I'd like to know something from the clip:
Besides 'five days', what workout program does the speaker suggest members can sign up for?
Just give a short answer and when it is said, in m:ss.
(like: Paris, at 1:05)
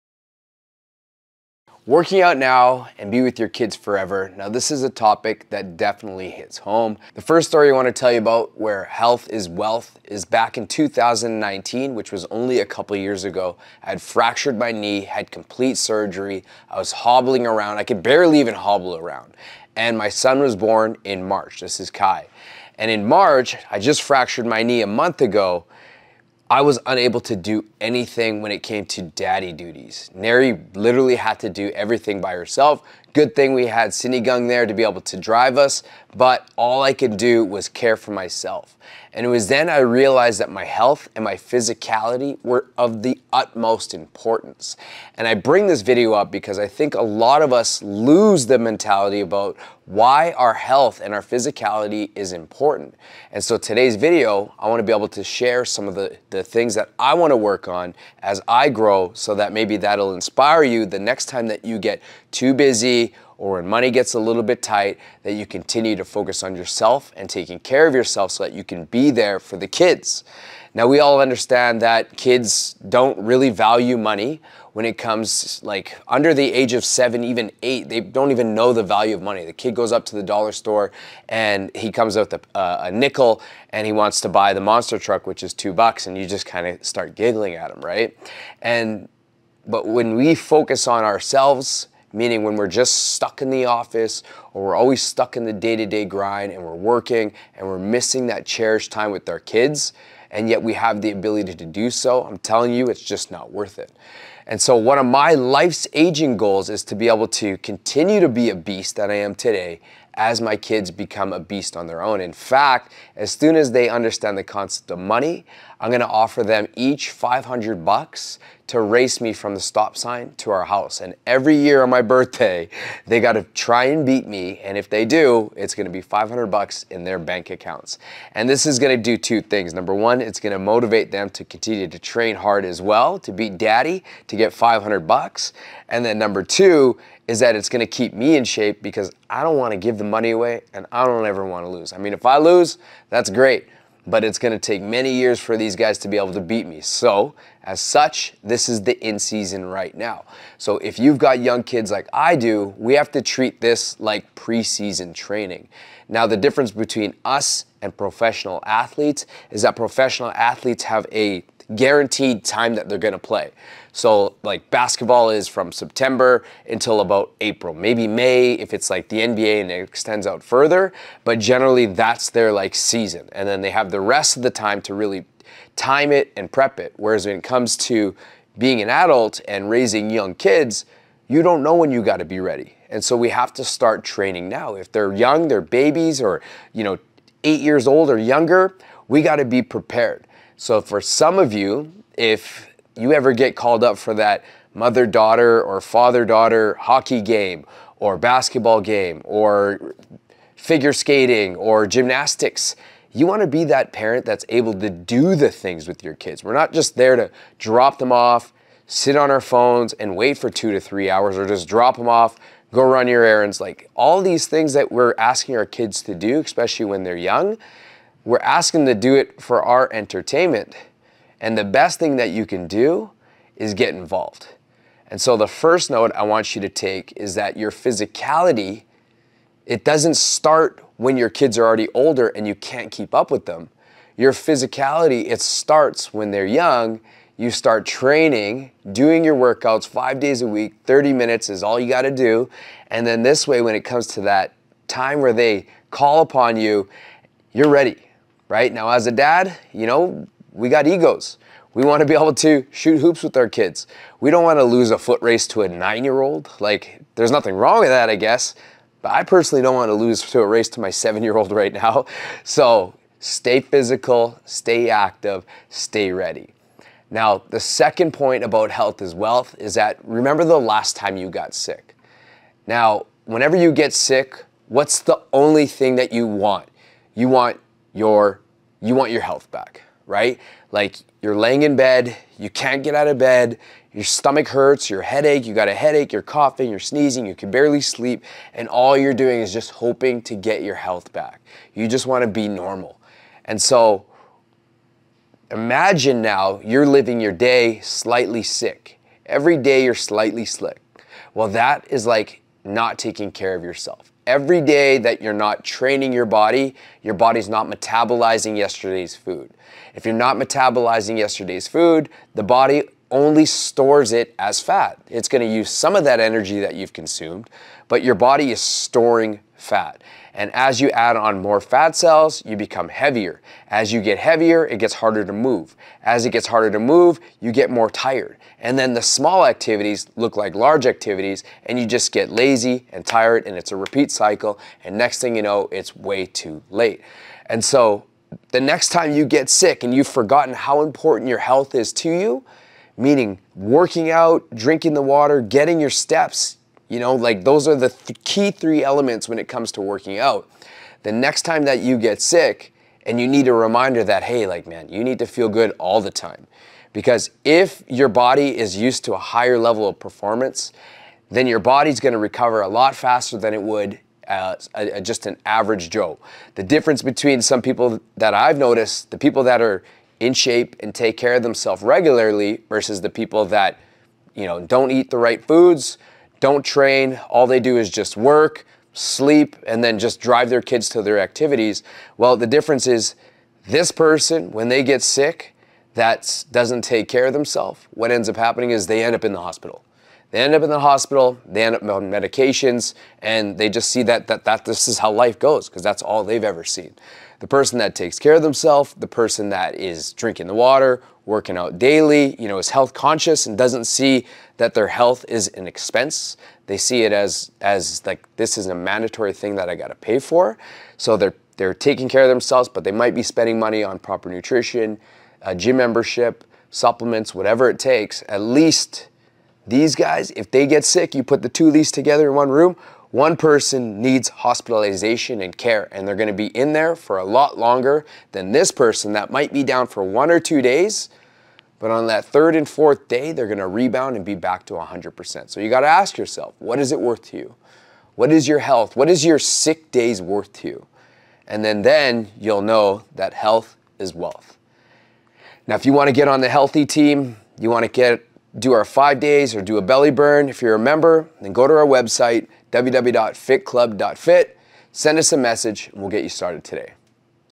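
Belly burn, at 7:29.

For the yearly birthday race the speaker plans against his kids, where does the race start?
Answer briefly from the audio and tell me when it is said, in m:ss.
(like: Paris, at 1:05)
The stop sign, at 1:59.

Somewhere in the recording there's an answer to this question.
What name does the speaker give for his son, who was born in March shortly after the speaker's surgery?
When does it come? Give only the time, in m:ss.
0:21.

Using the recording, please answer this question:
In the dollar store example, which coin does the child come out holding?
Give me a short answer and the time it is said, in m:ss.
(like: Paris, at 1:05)
A nickel, at 1:22.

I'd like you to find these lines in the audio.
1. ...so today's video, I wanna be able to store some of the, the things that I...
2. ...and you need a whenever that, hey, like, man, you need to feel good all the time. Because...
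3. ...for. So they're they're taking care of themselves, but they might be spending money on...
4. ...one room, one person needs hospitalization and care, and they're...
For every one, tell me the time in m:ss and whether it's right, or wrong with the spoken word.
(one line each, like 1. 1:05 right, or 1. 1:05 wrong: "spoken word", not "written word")
1. 0:53 wrong: "share", not "store"
2. 5:53 wrong: "reminder", not "whenever"
3. 6:50 right
4. 7:02 right.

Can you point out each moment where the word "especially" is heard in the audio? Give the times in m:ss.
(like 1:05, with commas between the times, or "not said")
3:36.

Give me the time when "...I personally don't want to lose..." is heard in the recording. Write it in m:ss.
4:19.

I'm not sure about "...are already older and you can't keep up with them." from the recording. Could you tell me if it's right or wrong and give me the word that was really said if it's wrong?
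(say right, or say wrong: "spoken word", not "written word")
right.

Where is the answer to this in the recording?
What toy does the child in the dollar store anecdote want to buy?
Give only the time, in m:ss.
1:24.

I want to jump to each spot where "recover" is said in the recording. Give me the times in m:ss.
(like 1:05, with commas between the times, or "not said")
6:02.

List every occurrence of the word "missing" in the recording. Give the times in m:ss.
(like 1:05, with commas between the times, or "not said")
1:37.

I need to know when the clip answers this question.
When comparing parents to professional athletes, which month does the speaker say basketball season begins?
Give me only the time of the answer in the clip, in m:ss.
2:45.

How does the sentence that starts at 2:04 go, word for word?
And if they do, it's going to be 500 bucks in their bank accounts.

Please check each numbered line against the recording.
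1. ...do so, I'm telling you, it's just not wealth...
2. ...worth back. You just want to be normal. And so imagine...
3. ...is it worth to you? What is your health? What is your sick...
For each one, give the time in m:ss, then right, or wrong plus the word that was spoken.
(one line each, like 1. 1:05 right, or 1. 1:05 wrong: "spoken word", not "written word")
1. 1:41 wrong: "worth", not "wealth"
2. 4:50 wrong: "health", not "worth"
3. 7:16 right.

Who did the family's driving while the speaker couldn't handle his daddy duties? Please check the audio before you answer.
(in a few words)
Cindy Gung.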